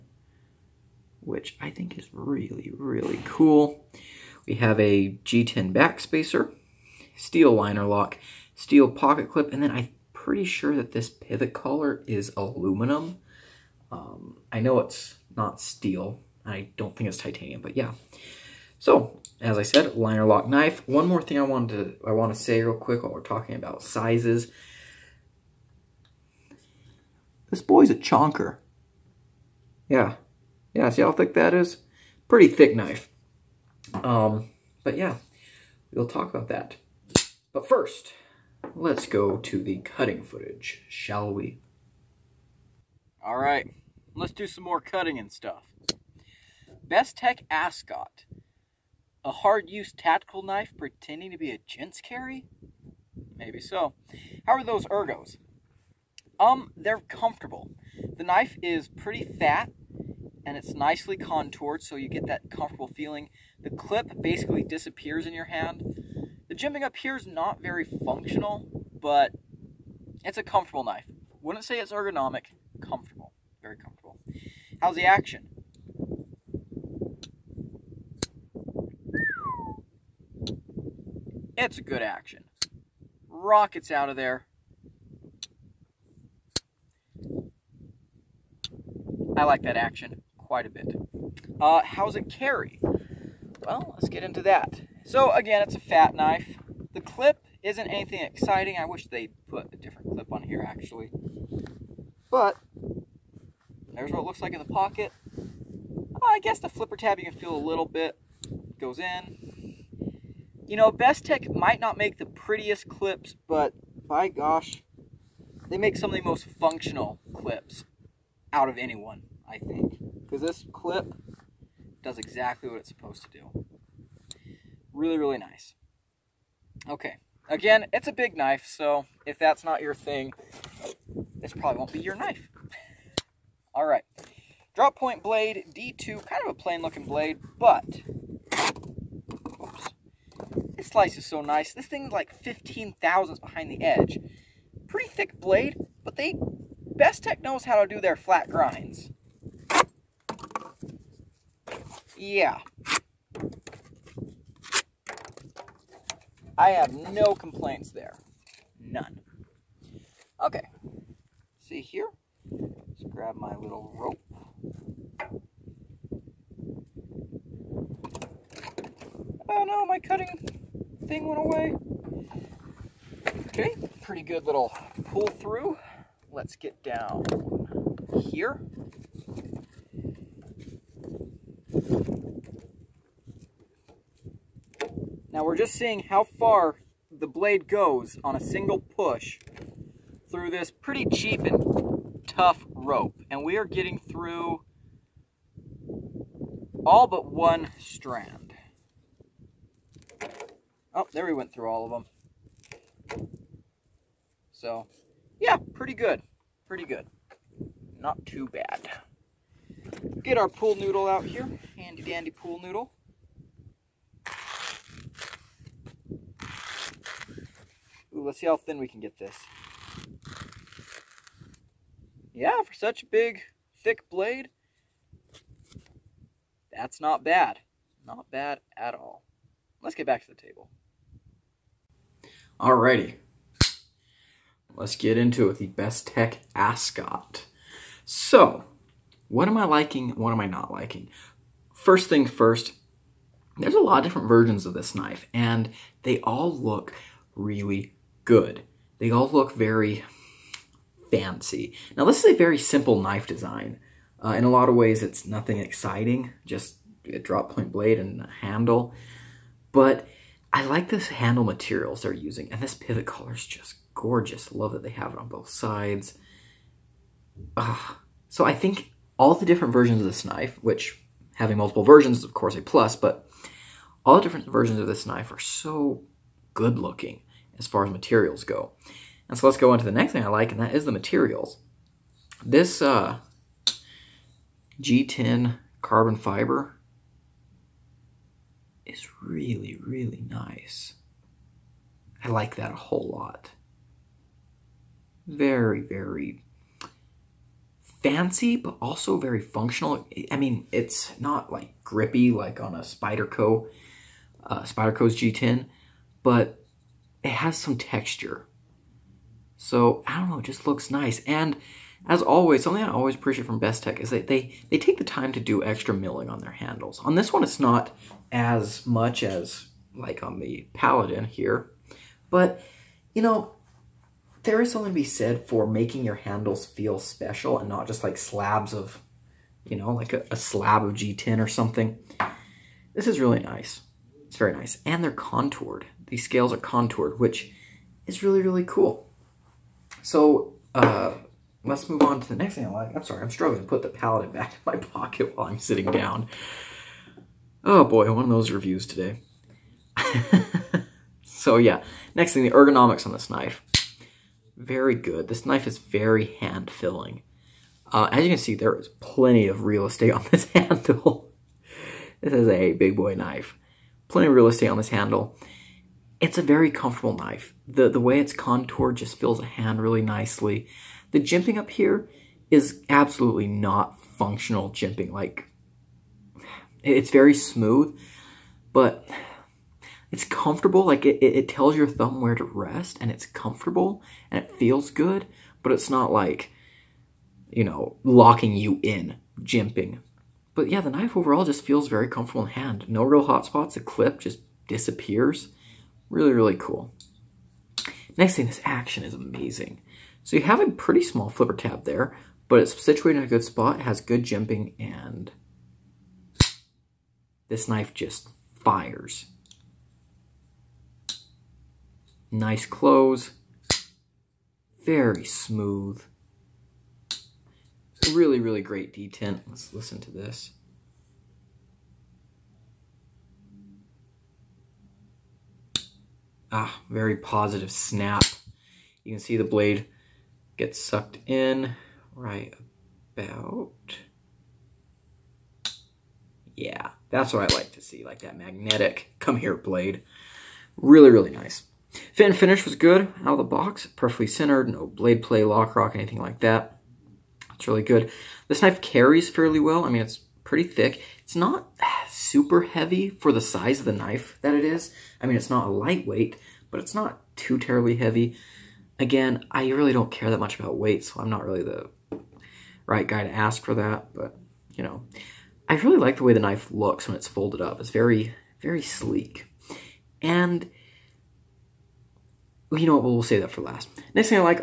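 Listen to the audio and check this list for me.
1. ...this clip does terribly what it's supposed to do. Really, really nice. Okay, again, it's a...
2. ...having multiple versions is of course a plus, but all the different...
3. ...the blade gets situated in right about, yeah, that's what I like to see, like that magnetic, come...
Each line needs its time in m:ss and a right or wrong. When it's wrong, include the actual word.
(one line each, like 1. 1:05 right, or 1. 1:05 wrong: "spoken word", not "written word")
1. 2:00 wrong: "exactly", not "terribly"
2. 4:31 right
3. 7:09 wrong: "sucked", not "situated".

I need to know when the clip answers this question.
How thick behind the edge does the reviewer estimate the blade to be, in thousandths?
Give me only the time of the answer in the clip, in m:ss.
2:22.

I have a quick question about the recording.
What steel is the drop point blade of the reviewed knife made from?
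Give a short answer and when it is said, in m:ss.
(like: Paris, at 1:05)
D2, at 2:15.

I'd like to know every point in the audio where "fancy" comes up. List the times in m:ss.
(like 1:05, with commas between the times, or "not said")
4:11, 4:58.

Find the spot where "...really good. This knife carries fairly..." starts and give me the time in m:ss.
7:27.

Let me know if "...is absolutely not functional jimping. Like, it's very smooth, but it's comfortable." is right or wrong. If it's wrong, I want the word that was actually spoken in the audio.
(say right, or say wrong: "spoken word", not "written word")
right.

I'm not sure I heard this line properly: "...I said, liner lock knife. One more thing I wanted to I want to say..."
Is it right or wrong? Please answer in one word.
right.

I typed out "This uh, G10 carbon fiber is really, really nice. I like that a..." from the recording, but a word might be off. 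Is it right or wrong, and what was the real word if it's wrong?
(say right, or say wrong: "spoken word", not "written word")
right.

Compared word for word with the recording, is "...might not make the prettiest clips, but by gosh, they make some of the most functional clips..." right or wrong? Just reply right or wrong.
right.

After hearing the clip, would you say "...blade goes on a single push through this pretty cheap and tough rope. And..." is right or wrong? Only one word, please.
right.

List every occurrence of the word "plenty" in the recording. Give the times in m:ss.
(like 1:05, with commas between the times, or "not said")
5:58, 6:04.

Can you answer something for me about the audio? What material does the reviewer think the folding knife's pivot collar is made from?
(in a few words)
aluminum.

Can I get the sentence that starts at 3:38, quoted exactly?
Ooh, let's see how thin we can get this.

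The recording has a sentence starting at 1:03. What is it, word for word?
The clip basically disappears in your hand.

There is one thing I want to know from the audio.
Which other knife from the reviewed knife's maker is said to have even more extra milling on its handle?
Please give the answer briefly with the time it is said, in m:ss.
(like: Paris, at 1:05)
Paladin, at 5:20.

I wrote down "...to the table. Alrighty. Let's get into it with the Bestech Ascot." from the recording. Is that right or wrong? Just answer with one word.
right.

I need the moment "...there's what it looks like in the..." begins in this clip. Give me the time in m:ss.
1:43.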